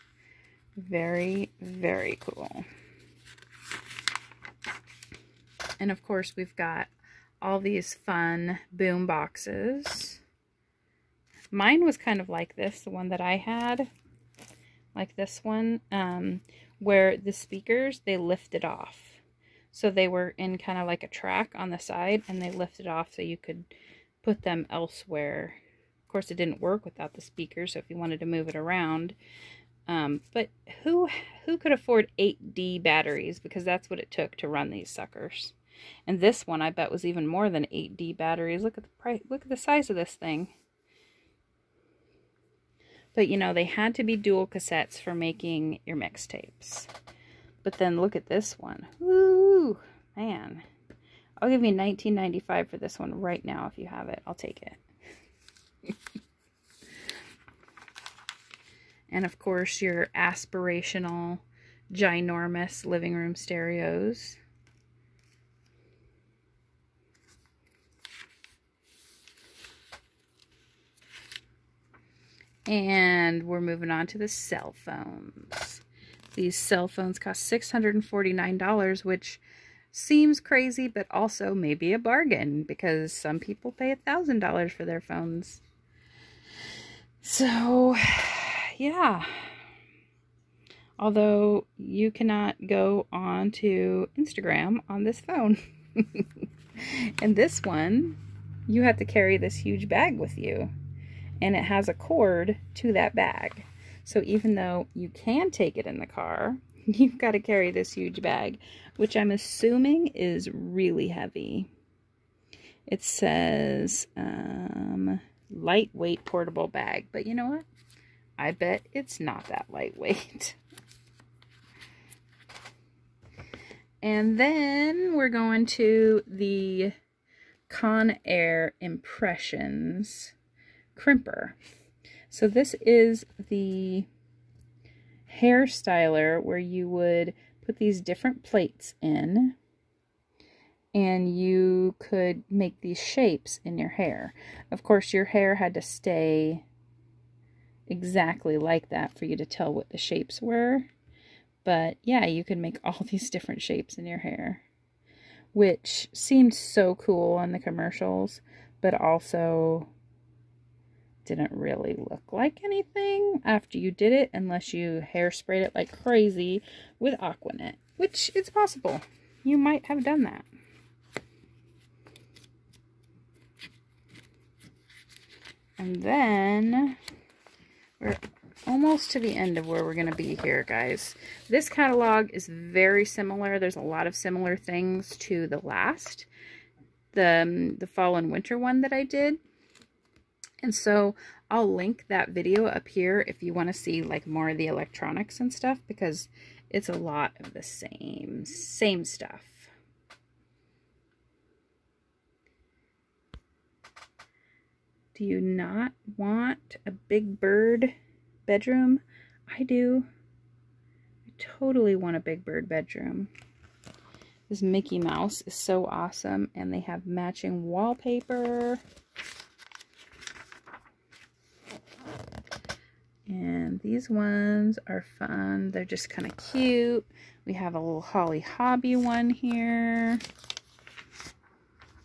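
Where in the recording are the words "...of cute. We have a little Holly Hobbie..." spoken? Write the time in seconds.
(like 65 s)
226 s.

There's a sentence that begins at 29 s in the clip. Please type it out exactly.
Um, but who who could afford 8D batteries?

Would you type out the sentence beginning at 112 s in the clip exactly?
It says, um, lightweight portable bag.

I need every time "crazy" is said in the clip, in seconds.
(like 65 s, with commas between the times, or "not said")
80 s, 166 s.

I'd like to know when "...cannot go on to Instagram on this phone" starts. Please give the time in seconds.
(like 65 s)
92 s.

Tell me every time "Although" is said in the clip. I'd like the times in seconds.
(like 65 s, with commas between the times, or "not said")
90 s.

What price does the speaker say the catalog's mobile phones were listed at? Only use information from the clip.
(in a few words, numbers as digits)
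$649.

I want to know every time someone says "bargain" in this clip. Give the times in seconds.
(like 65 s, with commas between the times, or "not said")
81 s.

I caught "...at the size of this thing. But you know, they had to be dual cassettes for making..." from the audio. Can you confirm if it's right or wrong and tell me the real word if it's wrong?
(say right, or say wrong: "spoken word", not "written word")
right.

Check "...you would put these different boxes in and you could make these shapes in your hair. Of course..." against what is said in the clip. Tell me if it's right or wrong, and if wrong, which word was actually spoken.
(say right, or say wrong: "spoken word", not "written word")
wrong: "plates", not "boxes".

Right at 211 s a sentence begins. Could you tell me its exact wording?
I totally want a big bird bedroom.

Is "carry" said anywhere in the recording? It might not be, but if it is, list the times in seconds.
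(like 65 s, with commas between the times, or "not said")
99 s, 107 s.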